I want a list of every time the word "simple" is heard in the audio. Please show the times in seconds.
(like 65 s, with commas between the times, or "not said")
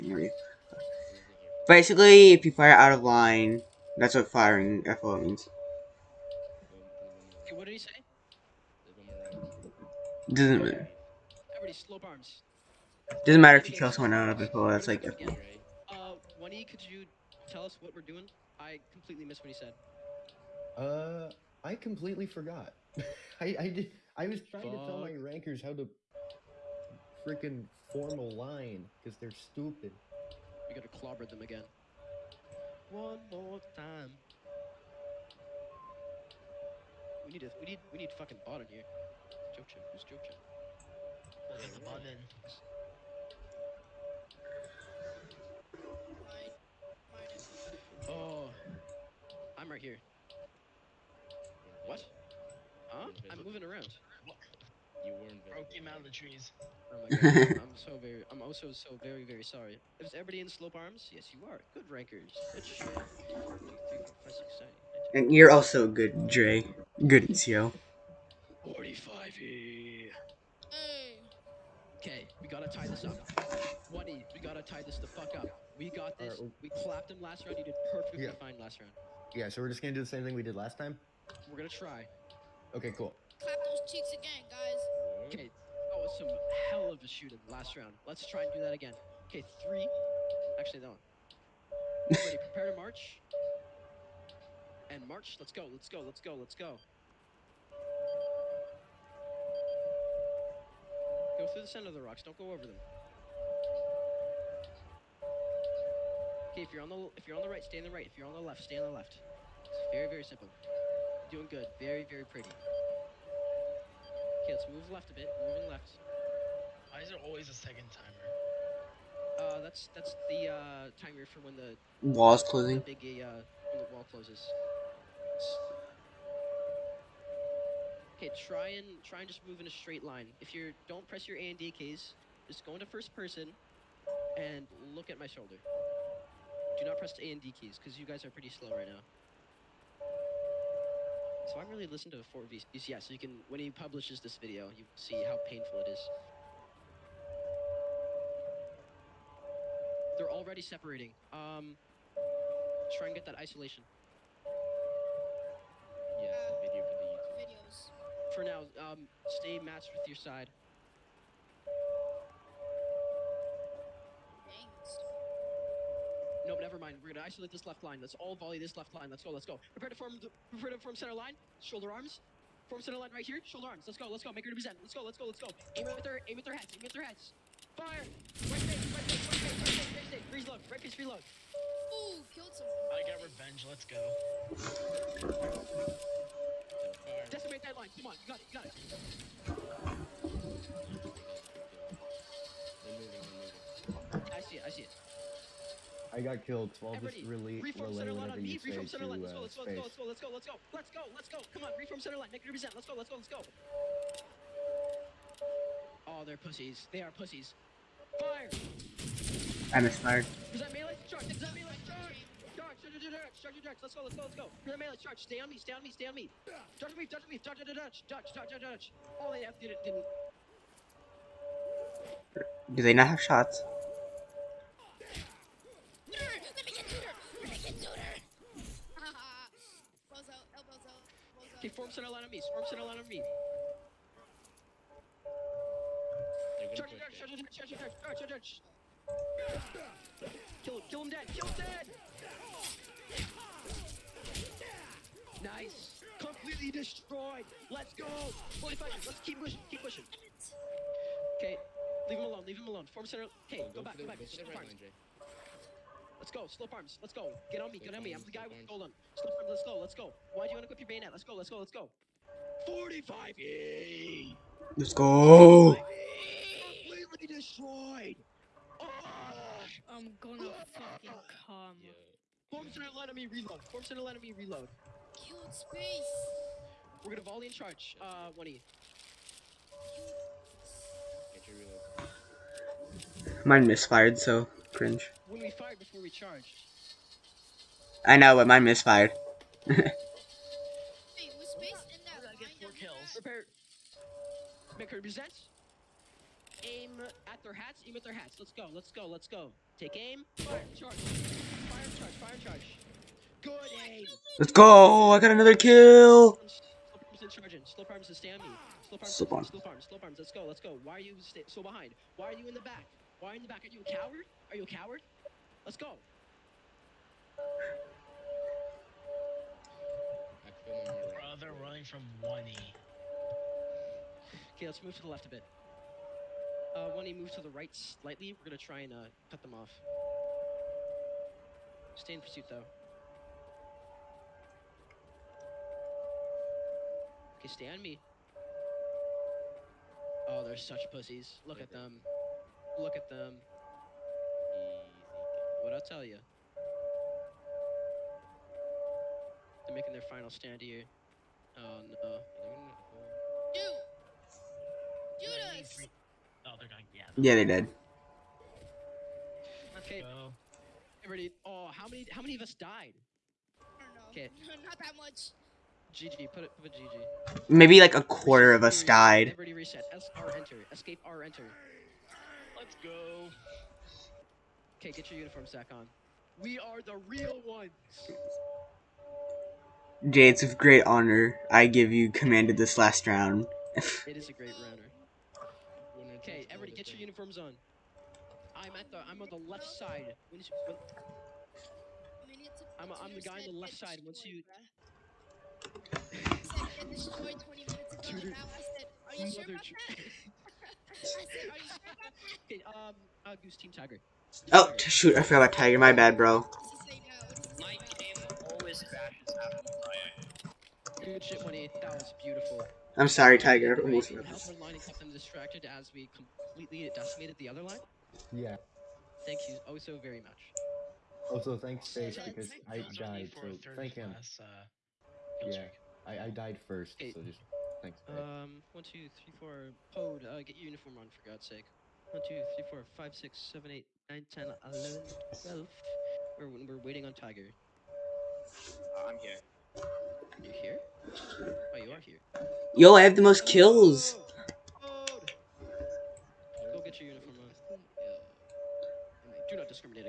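110 s.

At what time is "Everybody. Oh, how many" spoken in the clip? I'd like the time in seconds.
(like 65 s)
361 s.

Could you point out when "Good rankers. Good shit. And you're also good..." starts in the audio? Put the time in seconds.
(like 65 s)
61 s.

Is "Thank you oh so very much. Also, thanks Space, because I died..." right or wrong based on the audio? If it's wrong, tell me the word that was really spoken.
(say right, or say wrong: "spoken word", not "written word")
right.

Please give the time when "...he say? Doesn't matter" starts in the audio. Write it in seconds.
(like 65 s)
7 s.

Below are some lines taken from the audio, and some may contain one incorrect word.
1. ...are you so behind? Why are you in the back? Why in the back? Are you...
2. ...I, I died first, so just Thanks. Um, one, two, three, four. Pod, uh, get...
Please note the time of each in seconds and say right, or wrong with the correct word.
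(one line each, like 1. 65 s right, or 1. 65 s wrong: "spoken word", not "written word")
1. 310 s right
2. 426 s right.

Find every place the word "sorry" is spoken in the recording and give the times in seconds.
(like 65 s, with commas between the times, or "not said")
59 s, 413 s.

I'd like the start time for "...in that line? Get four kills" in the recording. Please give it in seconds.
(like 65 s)
291 s.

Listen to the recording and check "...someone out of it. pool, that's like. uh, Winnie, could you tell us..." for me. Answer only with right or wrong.
right.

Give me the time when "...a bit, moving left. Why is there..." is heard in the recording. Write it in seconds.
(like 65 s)
115 s.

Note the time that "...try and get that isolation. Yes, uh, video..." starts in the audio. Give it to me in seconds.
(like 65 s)
152 s.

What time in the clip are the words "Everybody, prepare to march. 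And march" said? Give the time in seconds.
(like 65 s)
92 s.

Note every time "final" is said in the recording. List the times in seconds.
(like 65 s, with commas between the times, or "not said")
350 s.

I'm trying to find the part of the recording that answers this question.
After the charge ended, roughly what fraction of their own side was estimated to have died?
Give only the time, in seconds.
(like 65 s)
367 s.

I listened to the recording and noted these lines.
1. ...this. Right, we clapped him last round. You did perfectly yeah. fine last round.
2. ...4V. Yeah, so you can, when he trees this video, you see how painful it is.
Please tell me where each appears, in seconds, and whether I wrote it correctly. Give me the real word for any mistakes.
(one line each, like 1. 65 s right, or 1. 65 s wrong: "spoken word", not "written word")
1. 76 s right
2. 142 s wrong: "publishes", not "trees".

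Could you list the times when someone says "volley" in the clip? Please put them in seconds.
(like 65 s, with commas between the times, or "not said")
168 s, 277 s.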